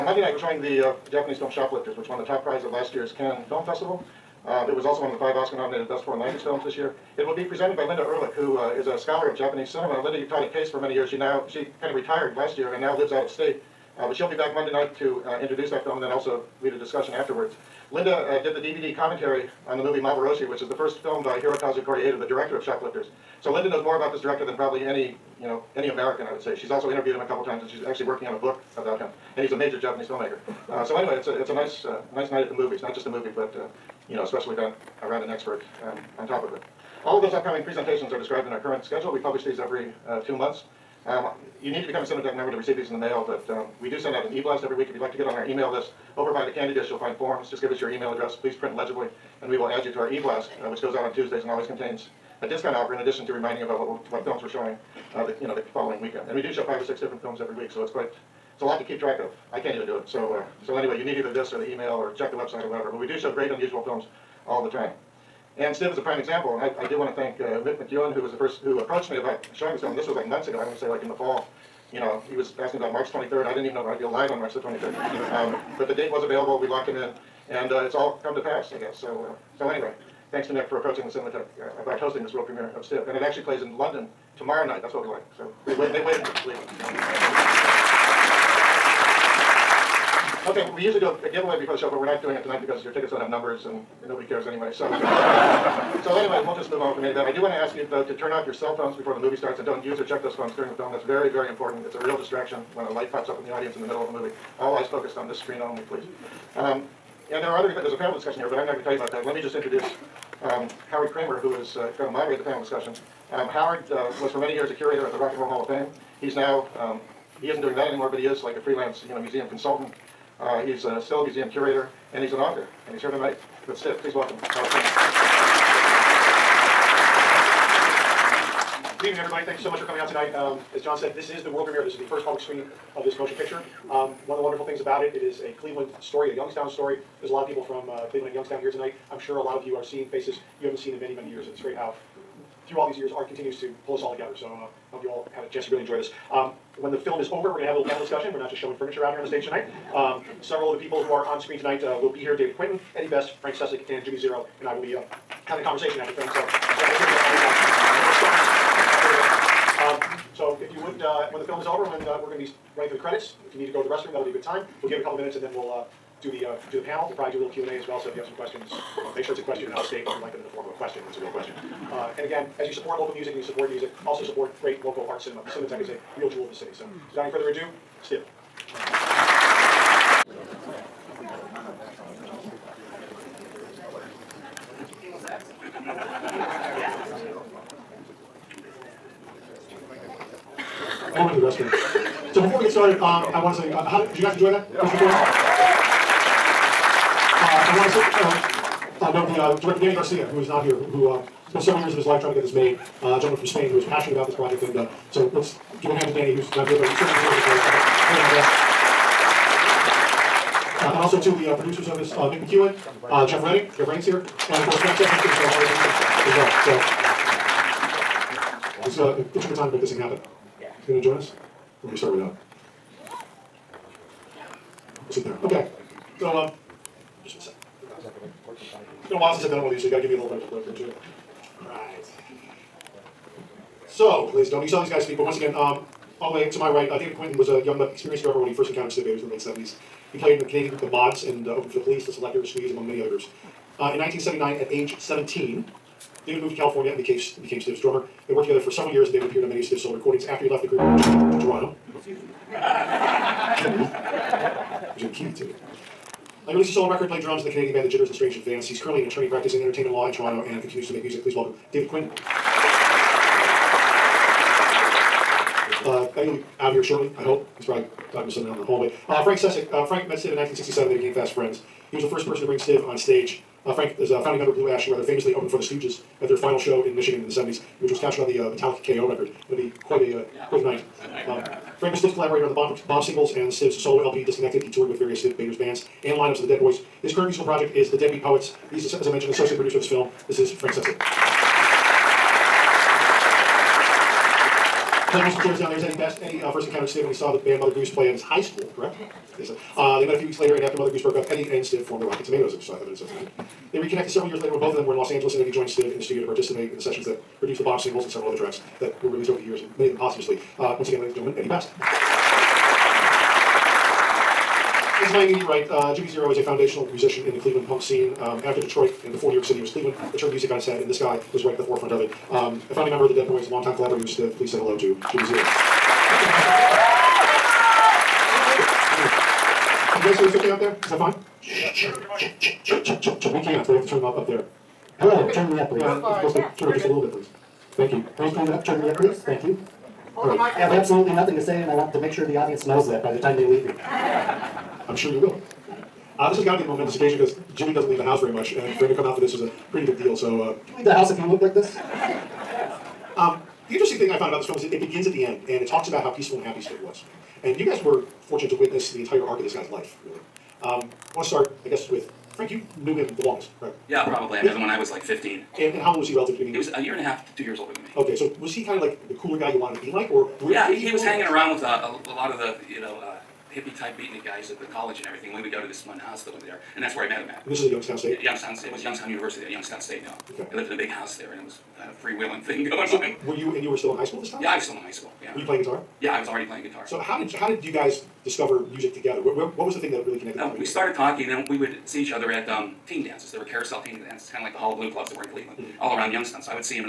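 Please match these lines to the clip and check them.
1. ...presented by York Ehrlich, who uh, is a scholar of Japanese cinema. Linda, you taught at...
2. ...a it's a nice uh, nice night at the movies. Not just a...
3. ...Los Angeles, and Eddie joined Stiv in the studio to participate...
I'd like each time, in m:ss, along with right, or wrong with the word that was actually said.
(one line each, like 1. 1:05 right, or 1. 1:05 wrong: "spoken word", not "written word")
1. 0:07 wrong: "Linda", not "York"
2. 0:31 right
3. 5:04 right.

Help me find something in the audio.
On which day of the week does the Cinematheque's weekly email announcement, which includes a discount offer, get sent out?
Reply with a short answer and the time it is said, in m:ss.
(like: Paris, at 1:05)
Tuesdays, at 0:51.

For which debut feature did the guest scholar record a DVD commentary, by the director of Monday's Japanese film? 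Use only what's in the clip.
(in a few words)
Maborosi.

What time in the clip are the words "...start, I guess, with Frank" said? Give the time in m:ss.
6:01.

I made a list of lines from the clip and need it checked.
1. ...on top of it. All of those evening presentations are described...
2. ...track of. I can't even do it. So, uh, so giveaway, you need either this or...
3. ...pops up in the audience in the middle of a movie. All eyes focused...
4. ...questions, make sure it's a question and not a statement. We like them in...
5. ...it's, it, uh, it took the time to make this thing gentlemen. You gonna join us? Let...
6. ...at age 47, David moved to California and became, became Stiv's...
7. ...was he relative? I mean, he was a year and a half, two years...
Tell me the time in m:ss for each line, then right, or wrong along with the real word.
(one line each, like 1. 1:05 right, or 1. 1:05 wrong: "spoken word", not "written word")
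1. 0:36 wrong: "upcoming", not "evening"
2. 0:58 wrong: "anyway", not "giveaway"
3. 1:43 right
4. 2:48 right
5. 3:38 wrong: "happen", not "gentlemen"
6. 4:04 wrong: "17", not "47"
7. 6:06 right.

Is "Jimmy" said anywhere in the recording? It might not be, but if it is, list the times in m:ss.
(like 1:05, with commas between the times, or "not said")
2:34, 4:14, 5:15, 5:25, 5:47.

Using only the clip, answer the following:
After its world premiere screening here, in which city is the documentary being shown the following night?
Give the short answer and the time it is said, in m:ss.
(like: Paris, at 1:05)
London, at 1:23.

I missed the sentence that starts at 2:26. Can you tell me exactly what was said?
Um, when the film is over, we're going to have a little panel discussion.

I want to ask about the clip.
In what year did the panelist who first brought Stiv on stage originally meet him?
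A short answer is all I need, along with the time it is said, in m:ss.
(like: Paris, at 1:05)
1967, at 4:30.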